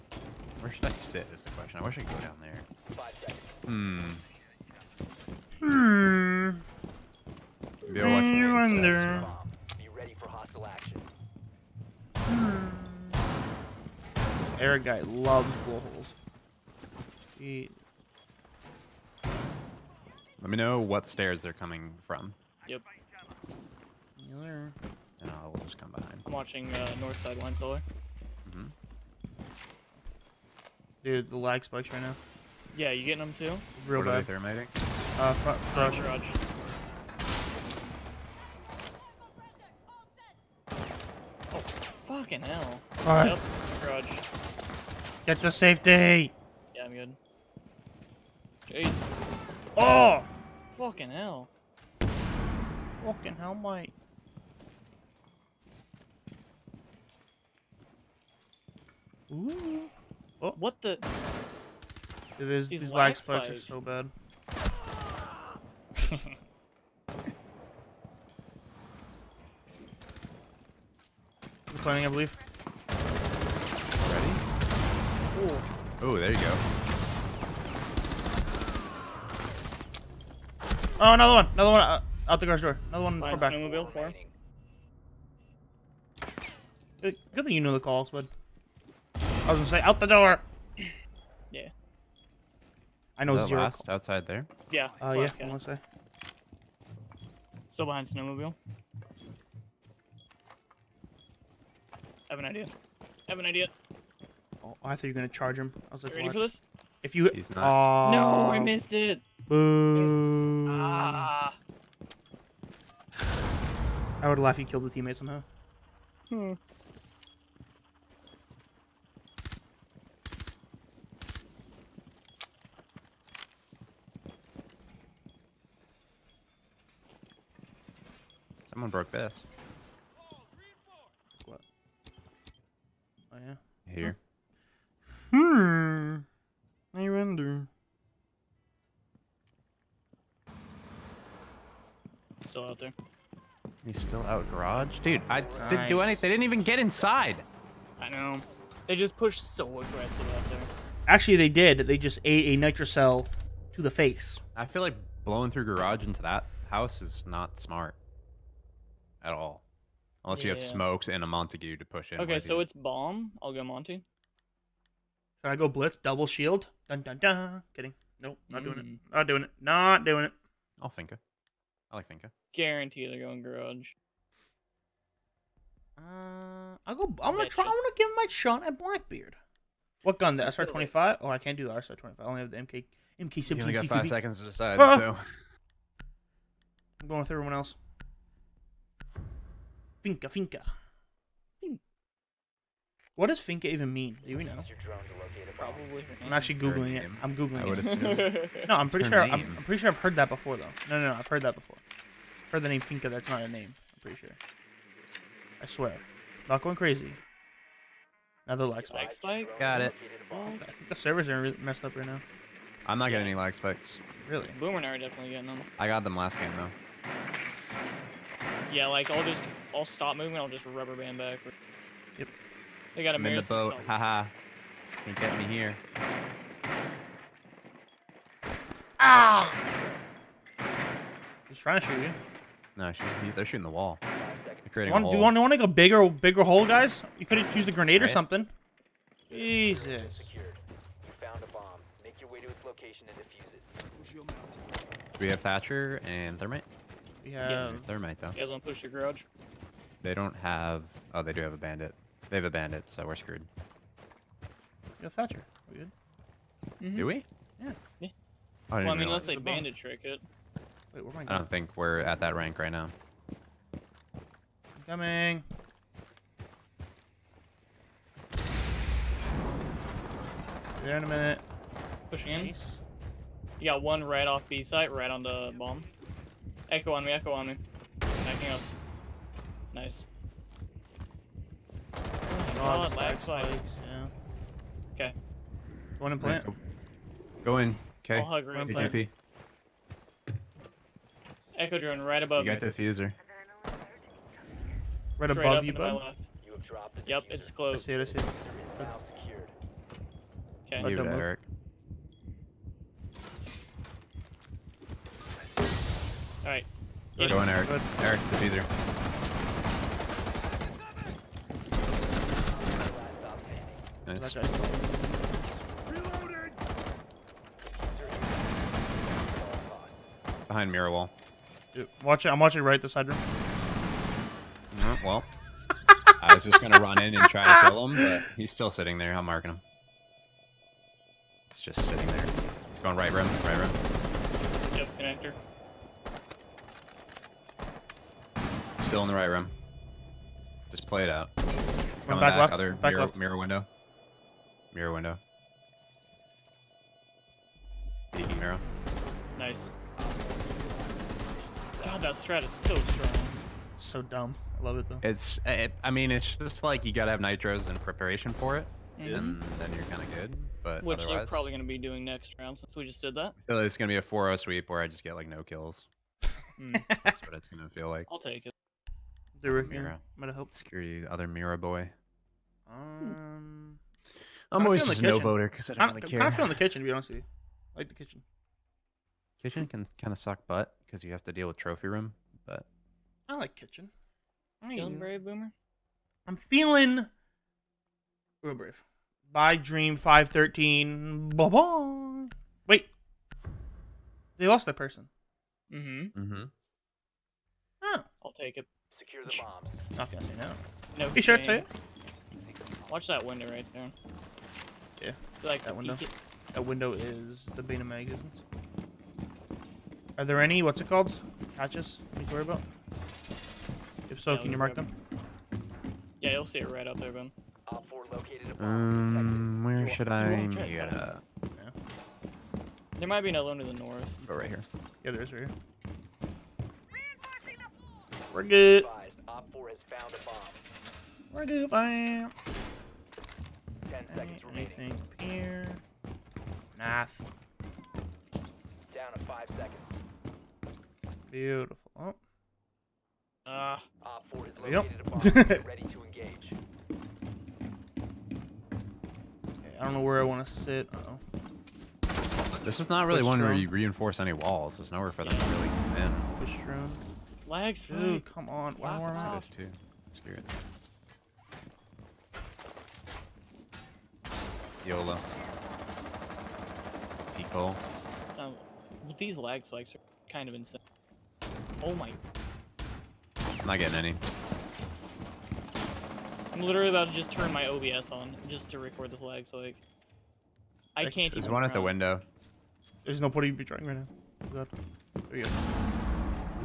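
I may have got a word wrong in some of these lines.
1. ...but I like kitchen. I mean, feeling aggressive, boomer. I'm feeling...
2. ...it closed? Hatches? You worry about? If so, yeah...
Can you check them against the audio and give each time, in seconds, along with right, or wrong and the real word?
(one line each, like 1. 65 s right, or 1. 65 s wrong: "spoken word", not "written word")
1. 382 s wrong: "brave", not "aggressive"
2. 410 s wrong: "called", not "closed".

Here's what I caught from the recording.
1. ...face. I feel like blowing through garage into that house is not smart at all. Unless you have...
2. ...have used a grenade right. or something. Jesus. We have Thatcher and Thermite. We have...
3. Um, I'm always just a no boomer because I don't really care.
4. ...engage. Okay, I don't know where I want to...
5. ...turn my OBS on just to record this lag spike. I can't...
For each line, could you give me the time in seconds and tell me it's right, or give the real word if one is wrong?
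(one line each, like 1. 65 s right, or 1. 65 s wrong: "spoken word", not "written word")
1. 153 s right
2. 237 s right
3. 373 s wrong: "voter", not "boomer"
4. 446 s right
5. 477 s right.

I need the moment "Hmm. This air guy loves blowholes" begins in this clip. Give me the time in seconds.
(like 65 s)
12 s.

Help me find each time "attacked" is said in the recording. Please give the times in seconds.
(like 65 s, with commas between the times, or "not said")
not said.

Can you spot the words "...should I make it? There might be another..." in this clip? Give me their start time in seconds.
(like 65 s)
419 s.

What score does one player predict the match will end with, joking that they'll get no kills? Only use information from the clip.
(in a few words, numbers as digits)
4-0.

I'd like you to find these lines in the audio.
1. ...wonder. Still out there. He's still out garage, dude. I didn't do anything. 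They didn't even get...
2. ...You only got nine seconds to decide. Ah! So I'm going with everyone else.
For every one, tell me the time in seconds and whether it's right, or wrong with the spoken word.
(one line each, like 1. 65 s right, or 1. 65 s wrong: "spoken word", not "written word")
1. 137 s right
2. 183 s wrong: "five", not "nine".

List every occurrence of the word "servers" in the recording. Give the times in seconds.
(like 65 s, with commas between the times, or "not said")
210 s.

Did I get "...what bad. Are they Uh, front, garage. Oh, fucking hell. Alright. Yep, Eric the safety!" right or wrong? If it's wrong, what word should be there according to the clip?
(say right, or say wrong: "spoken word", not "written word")
wrong: "Get", not "Eric".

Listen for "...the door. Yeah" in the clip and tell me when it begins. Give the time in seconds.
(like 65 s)
89 s.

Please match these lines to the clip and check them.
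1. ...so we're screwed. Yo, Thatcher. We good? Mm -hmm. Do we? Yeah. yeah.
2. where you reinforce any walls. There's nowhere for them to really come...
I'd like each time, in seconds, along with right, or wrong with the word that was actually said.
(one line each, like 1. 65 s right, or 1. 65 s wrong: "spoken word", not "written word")
1. 252 s right
2. 453 s right.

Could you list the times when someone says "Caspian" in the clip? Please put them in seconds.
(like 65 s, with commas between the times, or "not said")
not said.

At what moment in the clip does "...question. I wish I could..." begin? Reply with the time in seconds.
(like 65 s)
1 s.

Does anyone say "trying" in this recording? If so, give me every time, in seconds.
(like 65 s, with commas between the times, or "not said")
231 s, 483 s.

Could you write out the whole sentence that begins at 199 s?
I'm, I'm, pretty sure I've heard that before though.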